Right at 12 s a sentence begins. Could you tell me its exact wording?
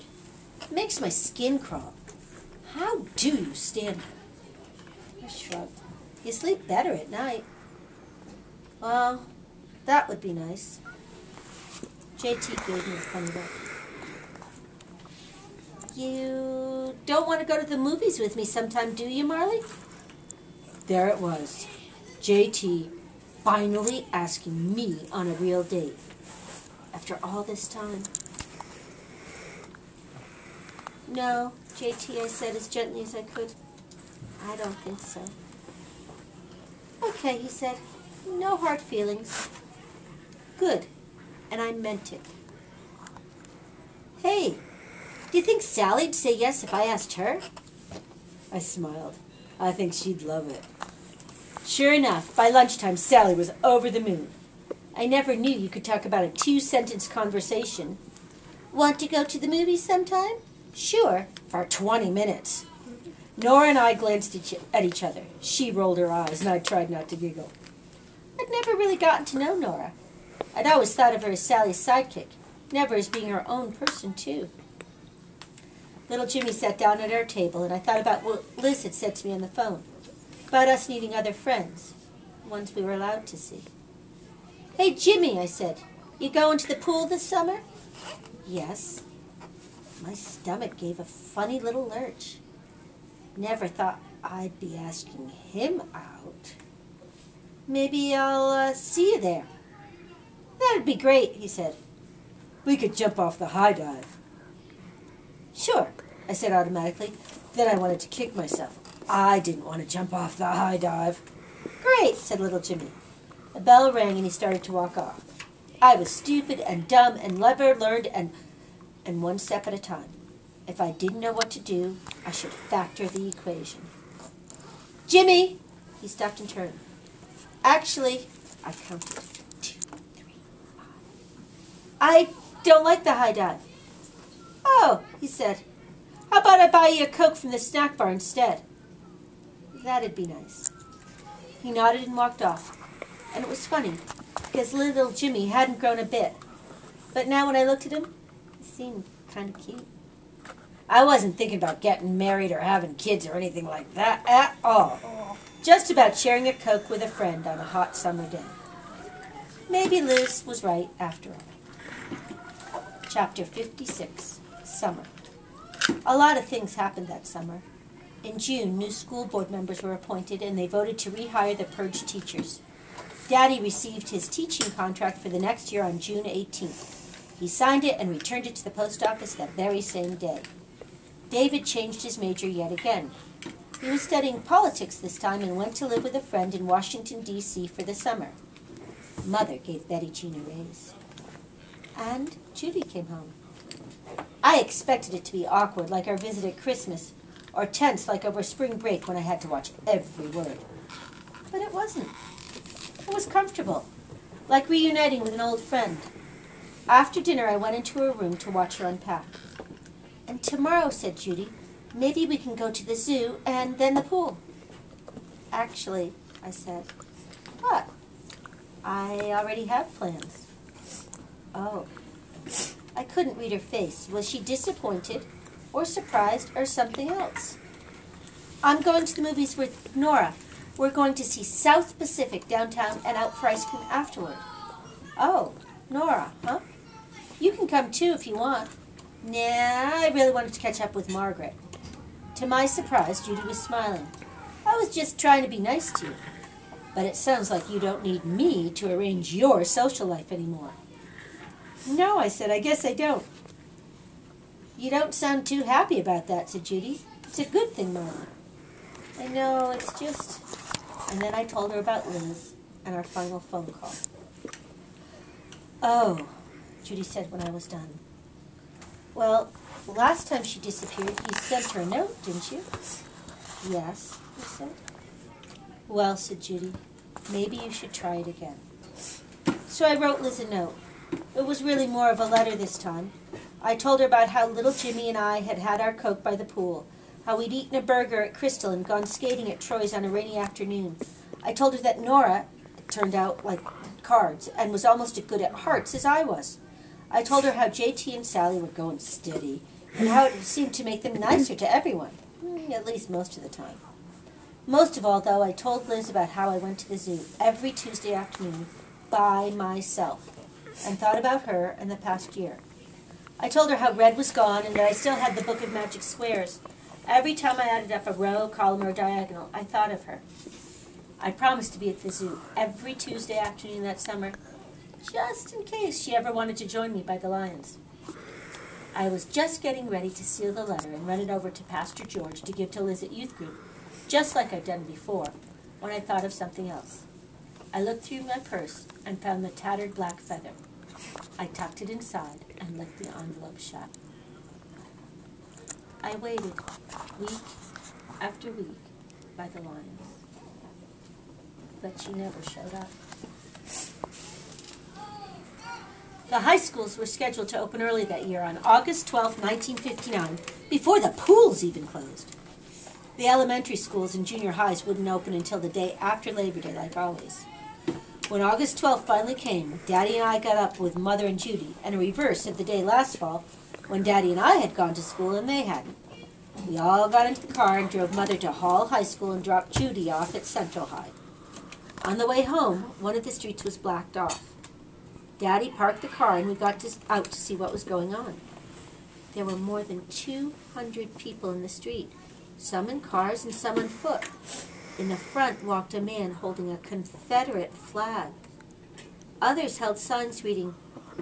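JT gave me a funny look.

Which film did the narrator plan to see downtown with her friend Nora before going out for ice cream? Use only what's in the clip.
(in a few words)
South Pacific.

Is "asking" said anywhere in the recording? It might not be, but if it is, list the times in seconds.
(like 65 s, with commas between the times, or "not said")
24 s, 94 s.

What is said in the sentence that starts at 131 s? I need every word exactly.
I don't like the high dive.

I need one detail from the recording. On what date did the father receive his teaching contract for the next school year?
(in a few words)
June 18th.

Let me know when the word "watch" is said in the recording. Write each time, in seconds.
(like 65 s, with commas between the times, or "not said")
199 s, 208 s.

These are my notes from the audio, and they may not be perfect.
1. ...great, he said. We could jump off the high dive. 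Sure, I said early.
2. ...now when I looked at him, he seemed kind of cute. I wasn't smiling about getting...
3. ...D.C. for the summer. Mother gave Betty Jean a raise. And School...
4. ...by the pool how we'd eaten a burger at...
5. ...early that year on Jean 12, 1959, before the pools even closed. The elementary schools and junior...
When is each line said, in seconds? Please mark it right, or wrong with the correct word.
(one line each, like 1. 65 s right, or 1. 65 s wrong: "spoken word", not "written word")
1. 100 s wrong: "automatically", not "early"
2. 147 s wrong: "thinking", not "smiling"
3. 187 s wrong: "Judy", not "School"
4. 286 s right
5. 357 s wrong: "August", not "Jean".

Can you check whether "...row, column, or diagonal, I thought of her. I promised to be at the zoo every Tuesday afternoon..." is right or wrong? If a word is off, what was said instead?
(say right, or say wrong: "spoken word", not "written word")
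right.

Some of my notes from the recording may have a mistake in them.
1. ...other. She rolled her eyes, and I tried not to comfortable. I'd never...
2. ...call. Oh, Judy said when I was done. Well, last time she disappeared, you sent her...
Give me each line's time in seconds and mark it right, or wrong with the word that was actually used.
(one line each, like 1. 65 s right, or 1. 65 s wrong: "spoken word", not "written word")
1. 65 s wrong: "giggle", not "comfortable"
2. 263 s right.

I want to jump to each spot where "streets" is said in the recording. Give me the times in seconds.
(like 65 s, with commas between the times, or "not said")
383 s, 391 s.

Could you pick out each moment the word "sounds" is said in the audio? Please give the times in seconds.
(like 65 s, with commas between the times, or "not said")
247 s, 255 s.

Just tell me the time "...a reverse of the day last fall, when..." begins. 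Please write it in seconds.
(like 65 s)
371 s.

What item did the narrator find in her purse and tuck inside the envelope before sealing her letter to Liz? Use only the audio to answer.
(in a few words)
black feather.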